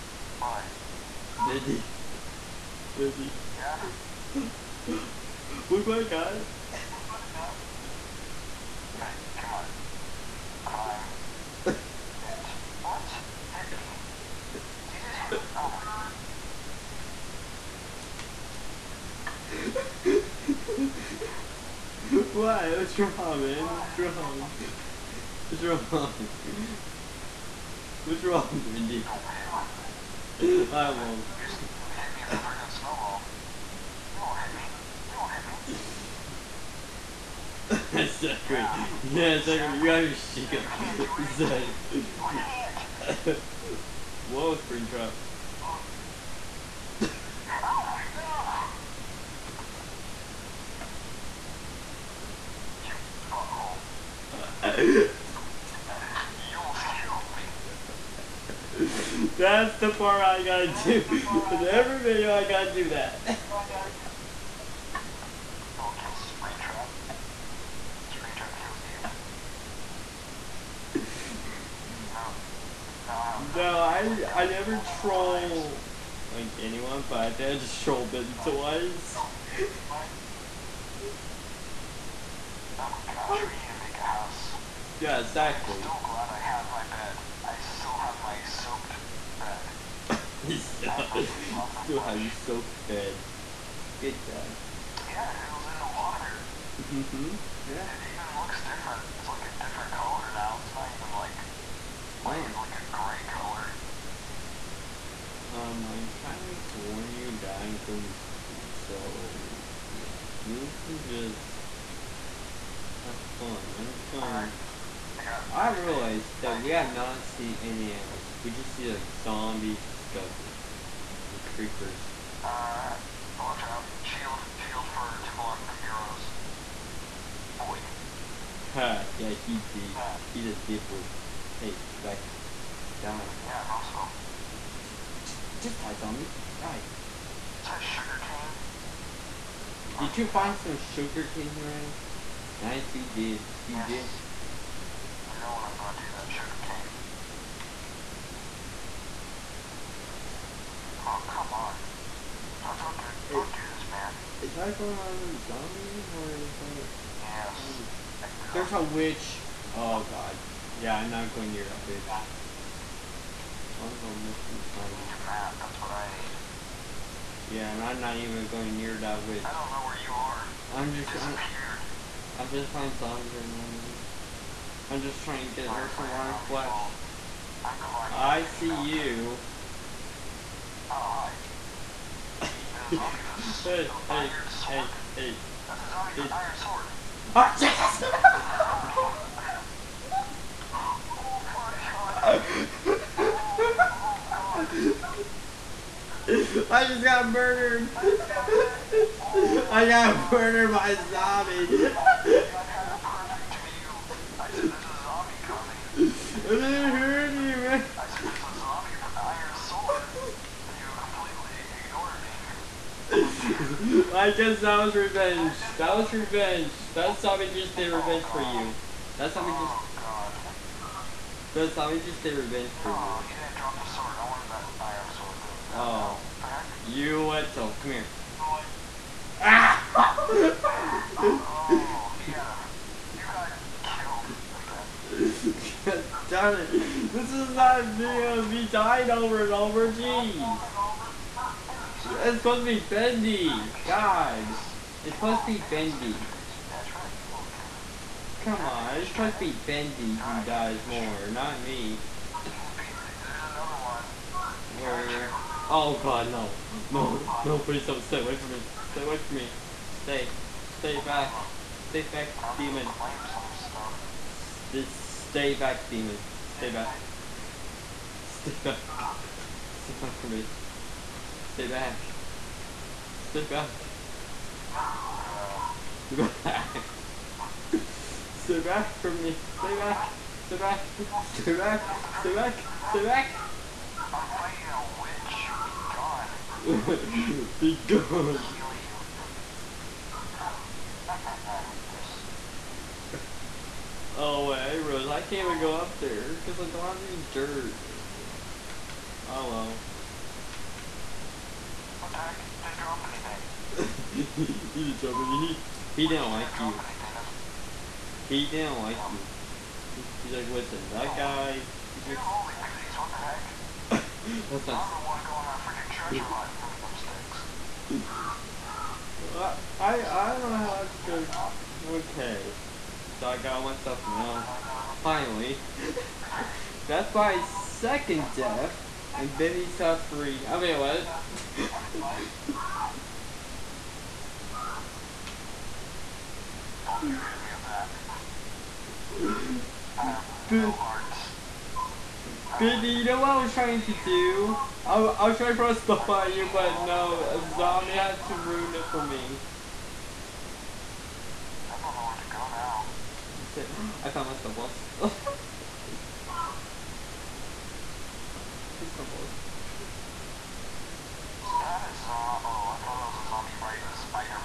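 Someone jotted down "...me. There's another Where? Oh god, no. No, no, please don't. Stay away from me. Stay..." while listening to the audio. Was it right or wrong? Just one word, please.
right.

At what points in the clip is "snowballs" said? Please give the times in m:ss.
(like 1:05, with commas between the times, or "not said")
5:54, 5:58.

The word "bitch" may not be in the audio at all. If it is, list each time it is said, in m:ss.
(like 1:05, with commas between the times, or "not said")
0:12, 2:41.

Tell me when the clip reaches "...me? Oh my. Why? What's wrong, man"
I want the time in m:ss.
0:20.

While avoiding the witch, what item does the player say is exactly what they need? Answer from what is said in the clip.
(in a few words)
a map.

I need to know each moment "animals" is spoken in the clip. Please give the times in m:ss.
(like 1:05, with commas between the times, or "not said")
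1:57.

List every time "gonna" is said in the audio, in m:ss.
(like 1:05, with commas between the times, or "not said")
1:47, 1:54, 2:25, 2:44.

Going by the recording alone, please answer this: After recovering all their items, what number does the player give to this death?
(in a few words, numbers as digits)
2.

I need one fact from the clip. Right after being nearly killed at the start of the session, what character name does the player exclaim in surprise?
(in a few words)
Springtrap.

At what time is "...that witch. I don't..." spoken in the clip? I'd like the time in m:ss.
2:48.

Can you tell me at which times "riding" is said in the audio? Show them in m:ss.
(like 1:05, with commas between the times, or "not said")
6:03.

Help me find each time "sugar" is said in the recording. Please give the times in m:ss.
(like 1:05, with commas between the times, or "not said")
2:20, 2:26.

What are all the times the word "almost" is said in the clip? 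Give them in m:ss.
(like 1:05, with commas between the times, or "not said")
0:56.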